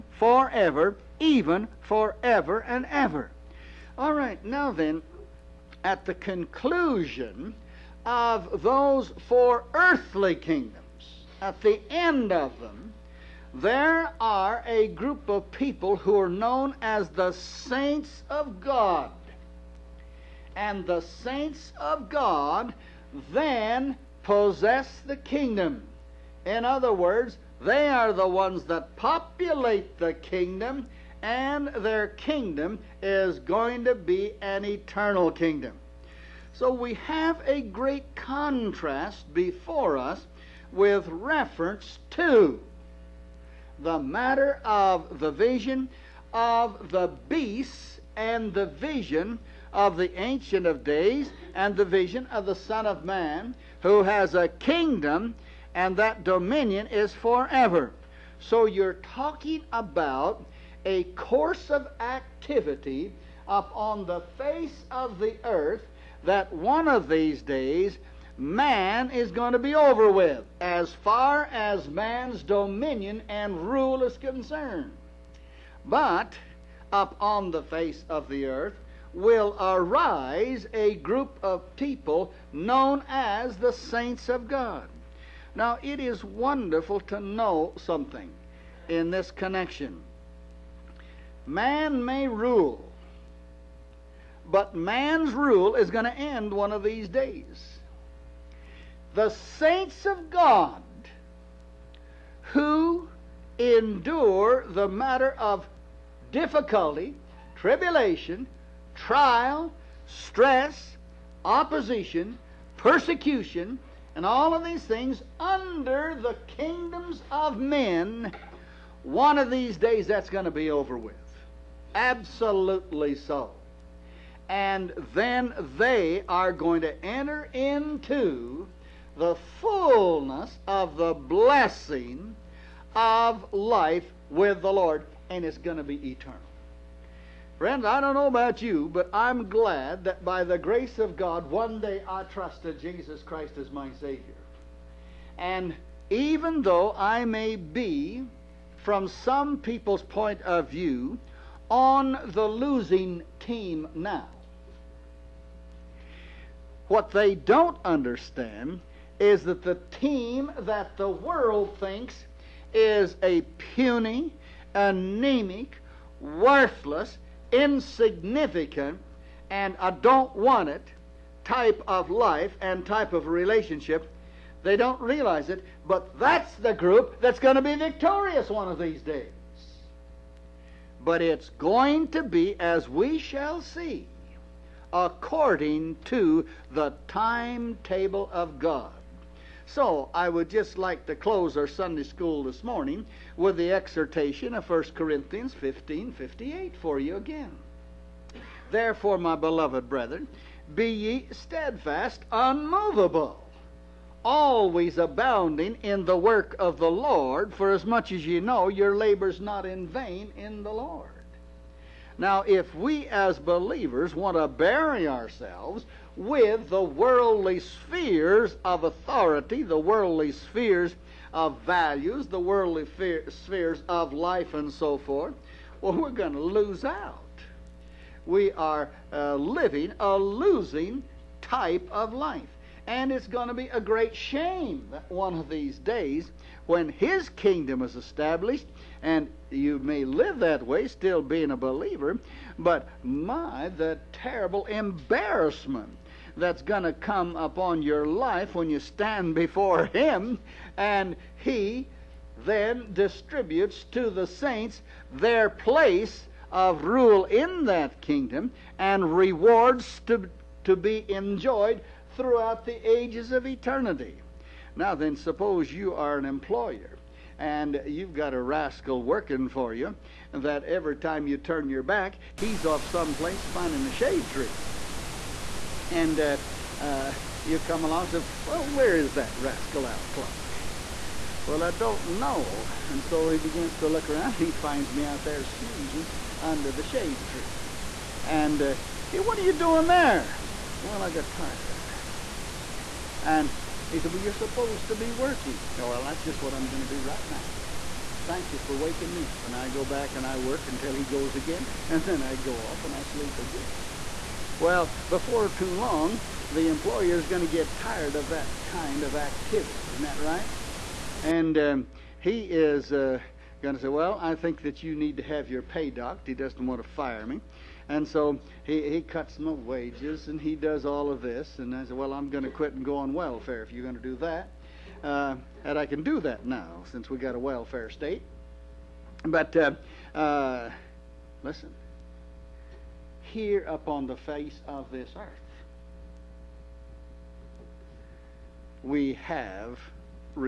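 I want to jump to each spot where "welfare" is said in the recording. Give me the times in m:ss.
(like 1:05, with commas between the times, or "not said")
5:23, 5:27.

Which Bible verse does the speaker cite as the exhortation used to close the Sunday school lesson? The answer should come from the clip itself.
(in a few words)
1 Corinthians 15:58.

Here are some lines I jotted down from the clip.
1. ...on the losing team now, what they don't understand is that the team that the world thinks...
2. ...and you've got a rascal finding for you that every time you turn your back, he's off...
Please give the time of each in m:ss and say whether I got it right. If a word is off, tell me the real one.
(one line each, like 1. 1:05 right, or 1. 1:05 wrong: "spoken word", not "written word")
1. 2:31 right
2. 4:27 wrong: "working", not "finding".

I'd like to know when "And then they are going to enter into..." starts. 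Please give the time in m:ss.
2:04.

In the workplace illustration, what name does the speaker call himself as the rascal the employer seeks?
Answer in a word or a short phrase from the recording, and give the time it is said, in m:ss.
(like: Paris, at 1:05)
Al Clock, at 4:39.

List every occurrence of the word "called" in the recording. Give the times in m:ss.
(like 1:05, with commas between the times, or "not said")
not said.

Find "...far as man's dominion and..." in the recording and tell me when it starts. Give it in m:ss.
1:11.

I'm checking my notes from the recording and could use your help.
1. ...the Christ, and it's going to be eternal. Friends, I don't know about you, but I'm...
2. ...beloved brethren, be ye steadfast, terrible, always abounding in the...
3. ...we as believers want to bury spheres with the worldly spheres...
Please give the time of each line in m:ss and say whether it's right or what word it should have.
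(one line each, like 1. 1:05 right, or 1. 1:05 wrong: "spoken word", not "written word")
1. 2:14 wrong: "Lord", not "Christ"
2. 3:19 wrong: "unmovable", not "terrible"
3. 3:32 wrong: "ourselves", not "spheres".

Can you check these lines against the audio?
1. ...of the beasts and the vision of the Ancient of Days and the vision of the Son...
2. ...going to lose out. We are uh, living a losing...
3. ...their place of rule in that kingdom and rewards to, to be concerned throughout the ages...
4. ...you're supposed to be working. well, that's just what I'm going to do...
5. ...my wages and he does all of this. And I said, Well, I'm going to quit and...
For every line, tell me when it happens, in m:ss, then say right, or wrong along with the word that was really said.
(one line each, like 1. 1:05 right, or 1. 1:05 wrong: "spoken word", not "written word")
1. 0:46 right
2. 3:46 right
3. 4:15 wrong: "enjoyed", not "concerned"
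4. 4:54 right
5. 5:19 right.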